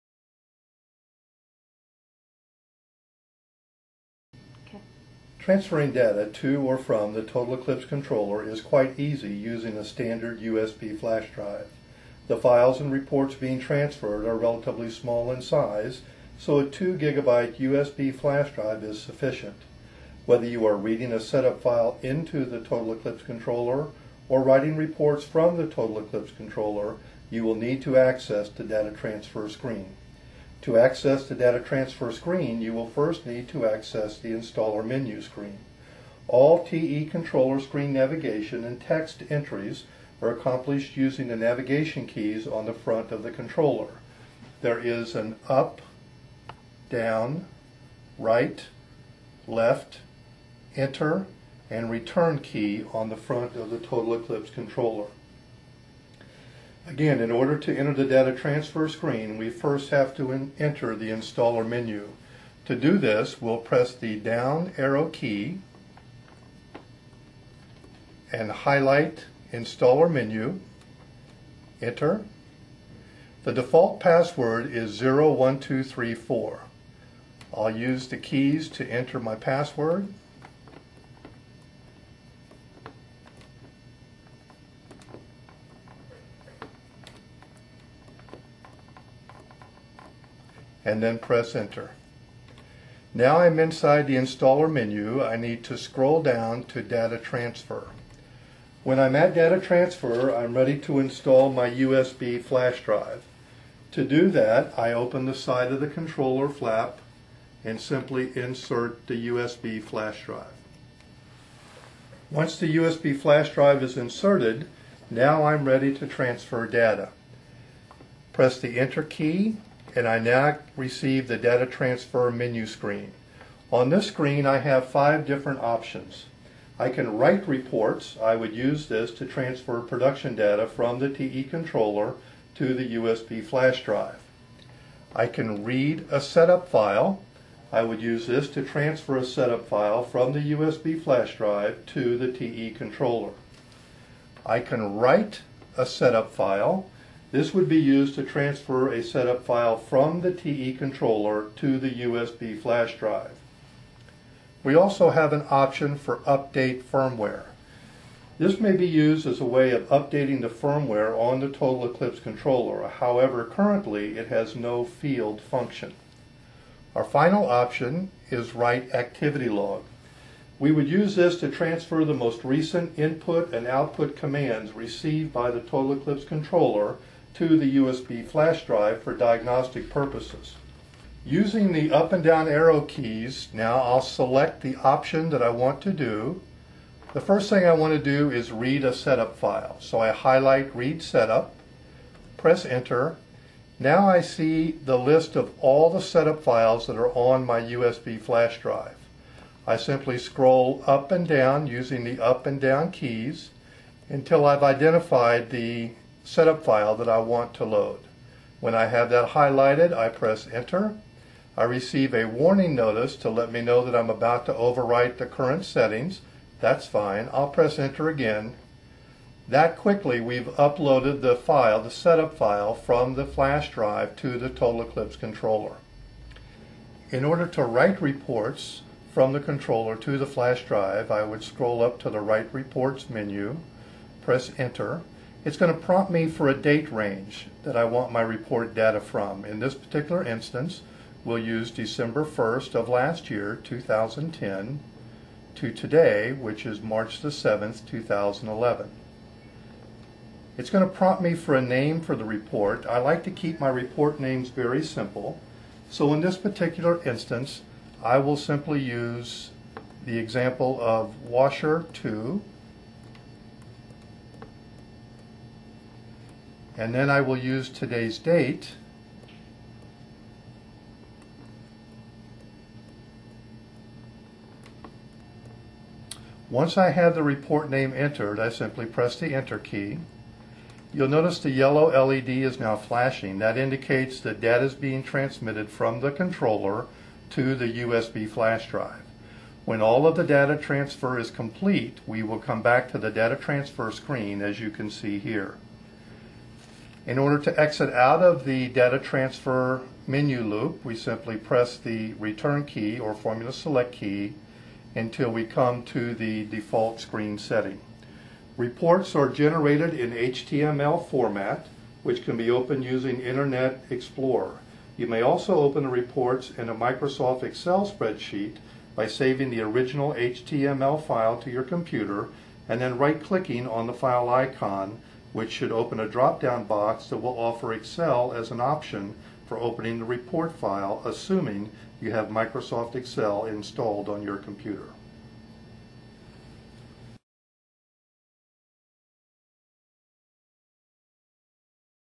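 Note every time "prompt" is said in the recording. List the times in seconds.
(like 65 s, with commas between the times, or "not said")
235 s, 250 s.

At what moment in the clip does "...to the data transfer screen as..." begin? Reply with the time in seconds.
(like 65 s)
292 s.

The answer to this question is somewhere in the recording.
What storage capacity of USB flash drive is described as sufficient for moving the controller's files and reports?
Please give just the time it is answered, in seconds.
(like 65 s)
16 s.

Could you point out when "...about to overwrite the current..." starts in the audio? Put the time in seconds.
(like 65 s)
214 s.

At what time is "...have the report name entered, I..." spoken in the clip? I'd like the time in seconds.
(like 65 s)
276 s.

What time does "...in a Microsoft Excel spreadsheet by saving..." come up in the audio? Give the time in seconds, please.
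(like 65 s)
316 s.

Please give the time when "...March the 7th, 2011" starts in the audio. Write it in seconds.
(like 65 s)
246 s.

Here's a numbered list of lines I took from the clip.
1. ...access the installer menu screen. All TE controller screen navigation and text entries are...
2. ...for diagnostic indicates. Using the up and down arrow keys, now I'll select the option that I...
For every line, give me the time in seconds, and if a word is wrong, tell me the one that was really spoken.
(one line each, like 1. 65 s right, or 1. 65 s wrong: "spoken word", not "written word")
1. 33 s right
2. 179 s wrong: "purposes", not "indicates".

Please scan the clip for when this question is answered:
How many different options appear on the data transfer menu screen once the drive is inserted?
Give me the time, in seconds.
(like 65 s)
124 s.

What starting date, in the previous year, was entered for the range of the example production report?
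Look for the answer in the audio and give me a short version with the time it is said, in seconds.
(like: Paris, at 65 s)
December 1st, 2010, at 241 s.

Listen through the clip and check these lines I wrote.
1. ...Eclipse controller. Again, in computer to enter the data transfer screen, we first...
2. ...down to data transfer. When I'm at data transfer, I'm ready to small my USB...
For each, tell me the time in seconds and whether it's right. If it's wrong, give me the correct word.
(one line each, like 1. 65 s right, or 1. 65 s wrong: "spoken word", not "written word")
1. 54 s wrong: "order", not "computer"
2. 96 s wrong: "install", not "small".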